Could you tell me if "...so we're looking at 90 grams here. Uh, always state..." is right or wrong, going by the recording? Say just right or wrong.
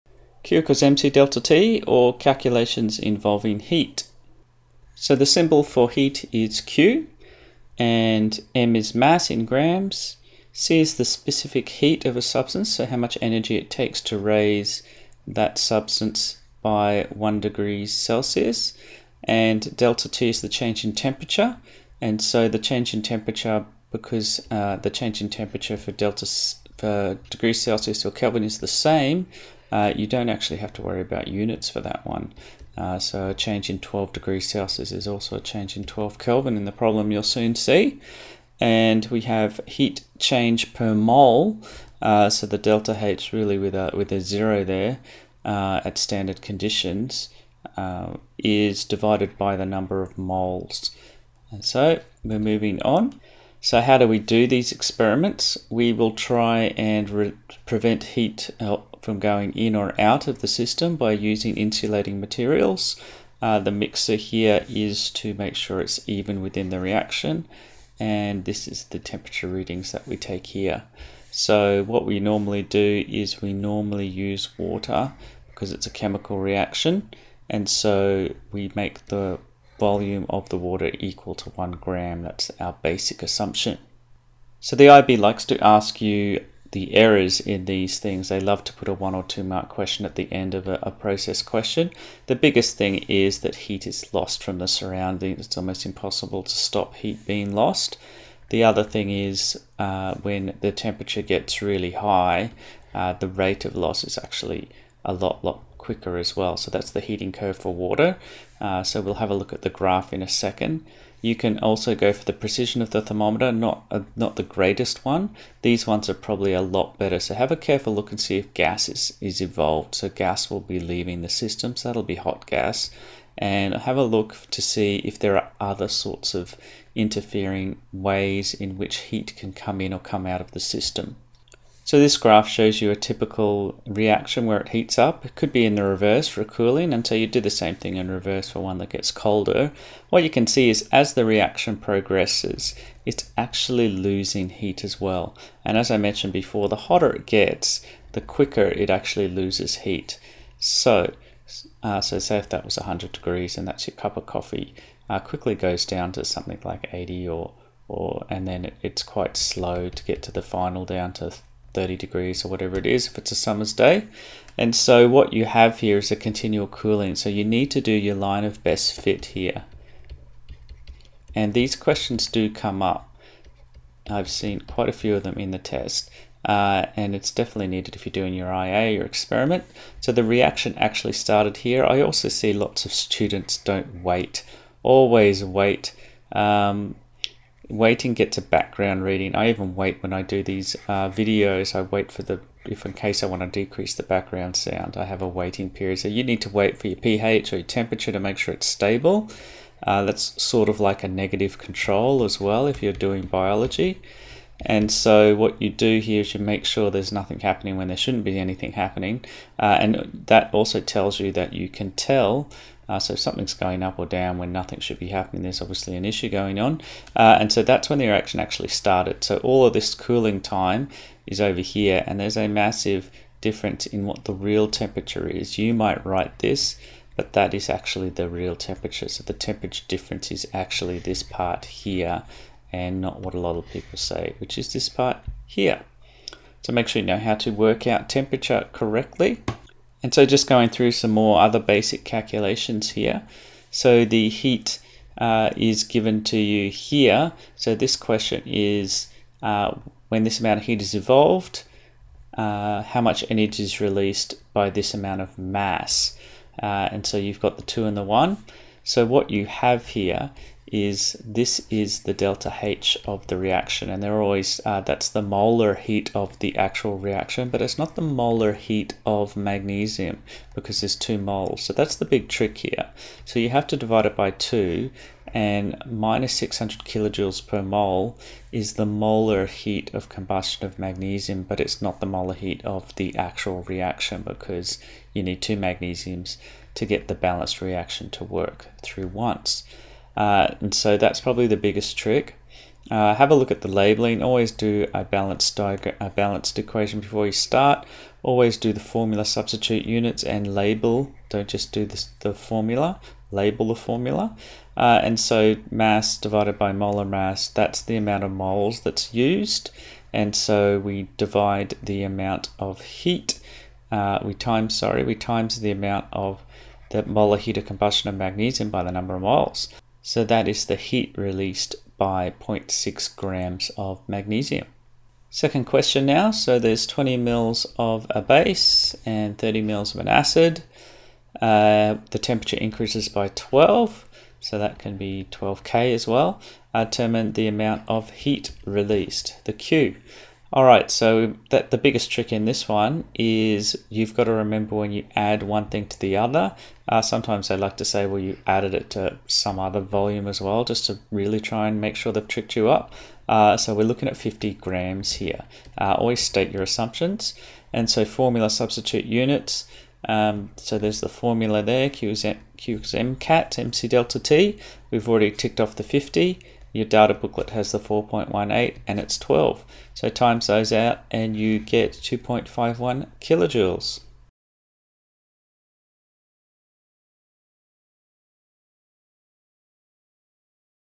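wrong.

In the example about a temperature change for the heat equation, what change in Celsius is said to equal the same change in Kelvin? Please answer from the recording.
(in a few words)
12 degrees.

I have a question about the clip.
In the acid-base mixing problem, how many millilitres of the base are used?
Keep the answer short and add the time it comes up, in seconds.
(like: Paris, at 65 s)
20, at 326 s.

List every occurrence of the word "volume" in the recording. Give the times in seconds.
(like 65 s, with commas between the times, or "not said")
79 s, 349 s.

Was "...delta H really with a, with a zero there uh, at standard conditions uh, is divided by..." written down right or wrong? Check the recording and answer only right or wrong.
right.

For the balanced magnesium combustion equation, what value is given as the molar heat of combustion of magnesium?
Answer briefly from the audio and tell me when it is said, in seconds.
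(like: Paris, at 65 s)
-600 kJ/mol, at 275 s.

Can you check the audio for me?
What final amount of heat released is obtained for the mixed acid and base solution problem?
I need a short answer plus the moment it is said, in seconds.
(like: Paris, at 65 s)
2.51 kJ, at 371 s.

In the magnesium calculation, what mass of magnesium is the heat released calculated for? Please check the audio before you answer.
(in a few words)
0.6 grams.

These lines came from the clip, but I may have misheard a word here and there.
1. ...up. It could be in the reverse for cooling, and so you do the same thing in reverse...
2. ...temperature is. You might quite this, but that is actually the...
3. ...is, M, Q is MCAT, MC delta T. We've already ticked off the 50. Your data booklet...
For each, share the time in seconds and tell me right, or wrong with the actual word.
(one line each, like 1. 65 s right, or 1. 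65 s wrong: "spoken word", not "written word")
1. 134 s right
2. 224 s wrong: "write", not "quite"
3. 362 s right.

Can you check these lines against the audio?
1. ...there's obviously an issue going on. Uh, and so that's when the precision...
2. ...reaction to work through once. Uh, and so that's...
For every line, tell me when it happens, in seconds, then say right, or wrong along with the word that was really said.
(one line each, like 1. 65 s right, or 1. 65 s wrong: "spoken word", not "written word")
1. 215 s wrong: "reaction", not "precision"
2. 287 s right.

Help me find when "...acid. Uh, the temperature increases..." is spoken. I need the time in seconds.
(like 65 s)
330 s.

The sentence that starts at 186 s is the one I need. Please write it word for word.
Um, waiting gets a background reading.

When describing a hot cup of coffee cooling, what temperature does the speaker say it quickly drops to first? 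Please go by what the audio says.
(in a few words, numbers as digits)
80.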